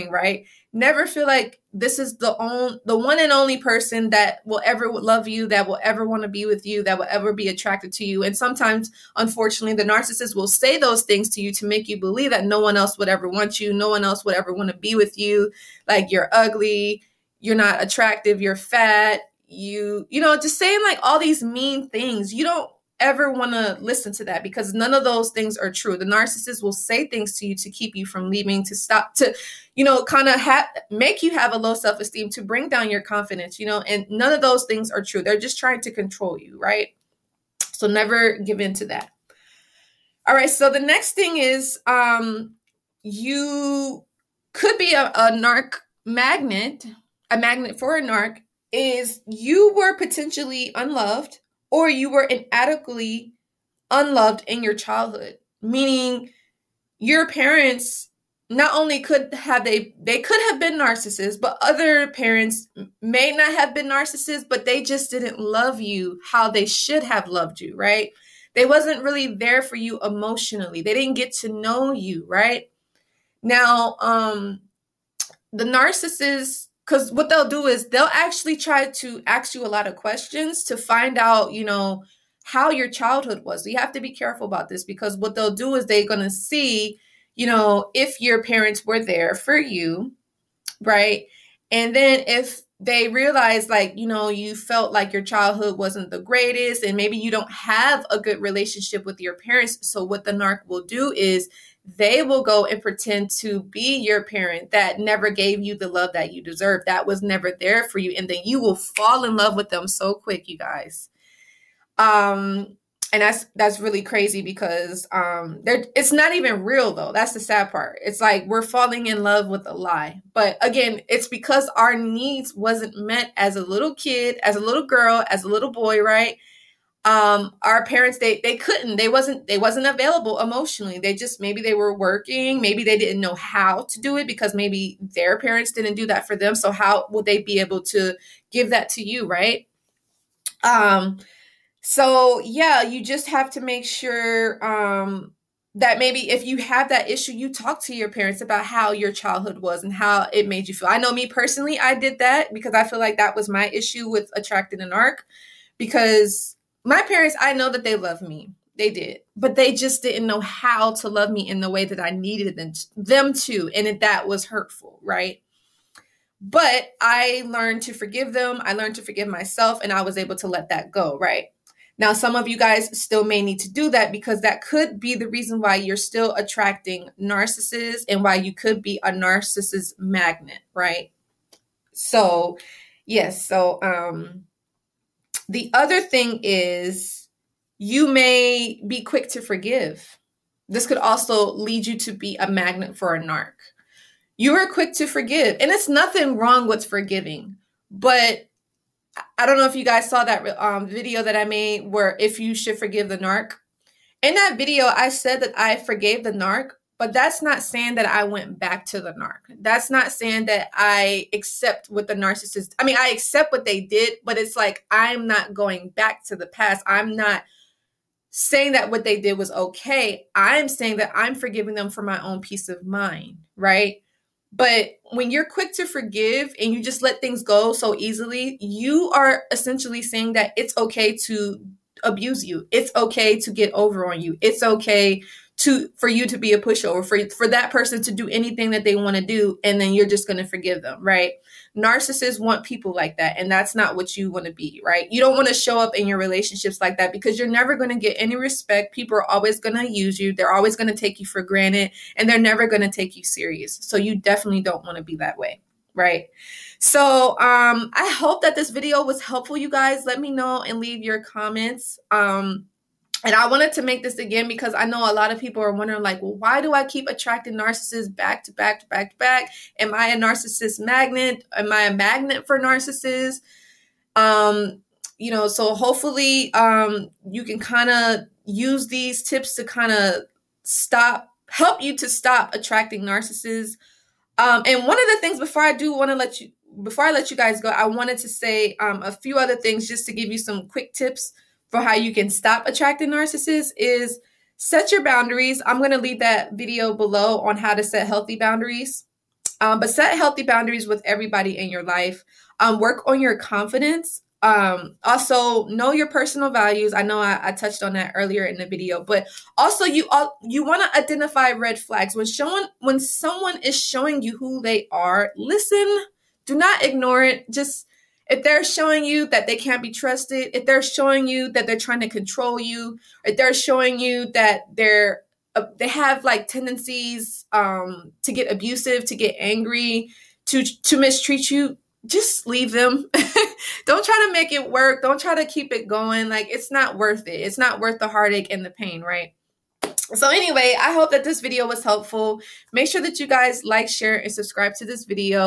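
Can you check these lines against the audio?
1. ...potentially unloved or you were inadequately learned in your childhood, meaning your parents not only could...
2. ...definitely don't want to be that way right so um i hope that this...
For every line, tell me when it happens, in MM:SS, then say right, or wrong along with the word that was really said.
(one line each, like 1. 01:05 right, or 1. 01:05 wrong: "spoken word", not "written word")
1. 00:49 wrong: "unloved", not "learned"
2. 04:14 right.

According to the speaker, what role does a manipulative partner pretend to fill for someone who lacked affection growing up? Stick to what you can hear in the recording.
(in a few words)
Your parent.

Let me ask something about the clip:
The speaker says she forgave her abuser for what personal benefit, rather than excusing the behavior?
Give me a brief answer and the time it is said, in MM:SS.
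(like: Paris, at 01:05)
Peace of mind, at 03:42.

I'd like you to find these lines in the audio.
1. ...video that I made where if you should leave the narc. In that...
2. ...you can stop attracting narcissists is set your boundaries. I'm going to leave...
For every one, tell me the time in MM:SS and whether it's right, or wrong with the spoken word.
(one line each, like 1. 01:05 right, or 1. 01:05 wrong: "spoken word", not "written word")
1. 03:20 wrong: "forgive", not "leave"
2. 04:51 right.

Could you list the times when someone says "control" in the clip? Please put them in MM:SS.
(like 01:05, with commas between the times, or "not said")
00:35, 05:22.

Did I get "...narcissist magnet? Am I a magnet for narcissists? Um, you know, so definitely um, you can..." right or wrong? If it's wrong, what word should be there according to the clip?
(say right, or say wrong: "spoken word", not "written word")
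wrong: "hopefully", not "definitely".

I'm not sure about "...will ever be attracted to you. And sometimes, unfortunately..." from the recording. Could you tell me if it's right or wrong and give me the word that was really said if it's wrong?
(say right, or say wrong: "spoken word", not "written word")
right.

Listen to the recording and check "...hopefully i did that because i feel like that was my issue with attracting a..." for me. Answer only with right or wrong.
wrong.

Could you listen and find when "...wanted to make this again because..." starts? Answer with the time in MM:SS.
04:23.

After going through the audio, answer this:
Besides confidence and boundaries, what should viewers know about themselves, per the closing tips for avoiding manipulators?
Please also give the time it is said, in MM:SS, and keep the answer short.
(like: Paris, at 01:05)
Personal values, at 05:06.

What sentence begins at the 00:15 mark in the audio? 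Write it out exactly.
Like you're ugly, you're not attractive, you're fat, you you know, just saying like all these mean things.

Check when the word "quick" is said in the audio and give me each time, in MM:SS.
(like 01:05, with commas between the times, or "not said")
01:50, 03:09, 03:14, 03:45, 04:50.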